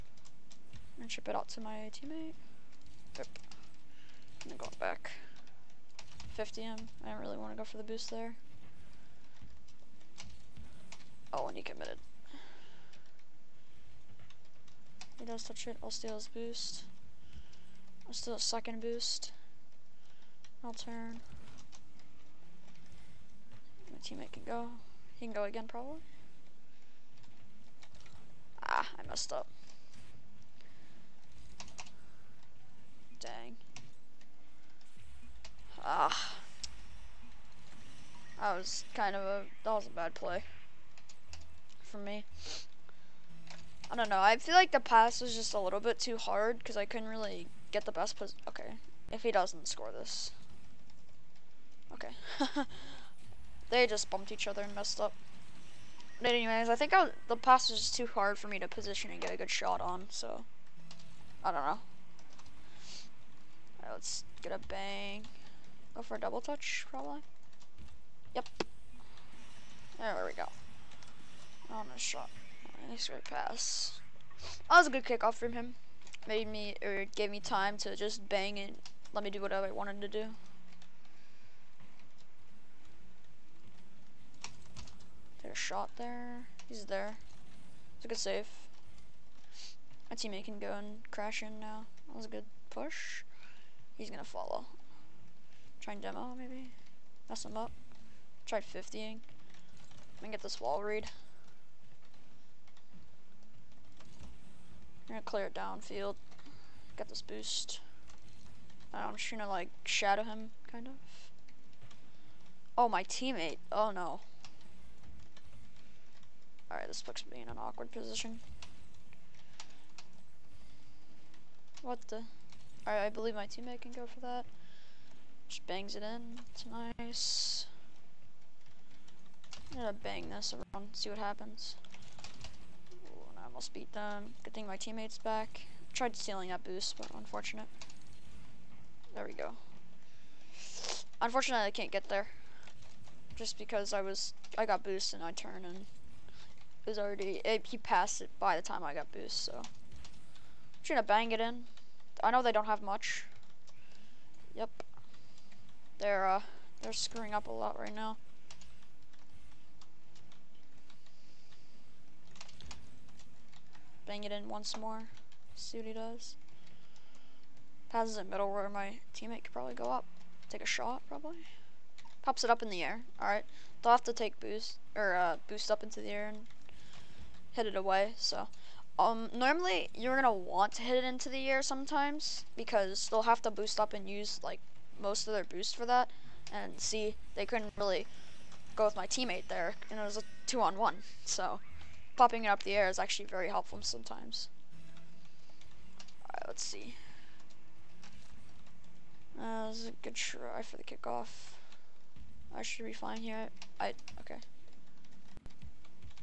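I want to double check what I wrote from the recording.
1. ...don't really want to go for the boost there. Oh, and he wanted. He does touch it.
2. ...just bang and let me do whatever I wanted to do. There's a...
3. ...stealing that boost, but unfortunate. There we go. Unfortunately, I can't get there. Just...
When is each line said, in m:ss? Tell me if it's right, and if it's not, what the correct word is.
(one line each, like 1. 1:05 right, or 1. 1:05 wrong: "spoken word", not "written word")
1. 0:07 wrong: "committed", not "wanted"
2. 1:17 right
3. 2:16 right.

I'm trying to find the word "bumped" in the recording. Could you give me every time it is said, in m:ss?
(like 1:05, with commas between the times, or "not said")
0:54.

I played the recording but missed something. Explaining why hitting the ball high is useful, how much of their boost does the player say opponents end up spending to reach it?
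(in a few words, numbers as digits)
most of their boost.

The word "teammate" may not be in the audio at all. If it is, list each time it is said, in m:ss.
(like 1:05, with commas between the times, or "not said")
0:01, 0:23, 1:30, 1:53, 2:03, 2:14, 2:49, 3:09.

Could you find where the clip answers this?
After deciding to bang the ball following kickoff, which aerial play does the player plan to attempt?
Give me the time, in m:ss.
1:06.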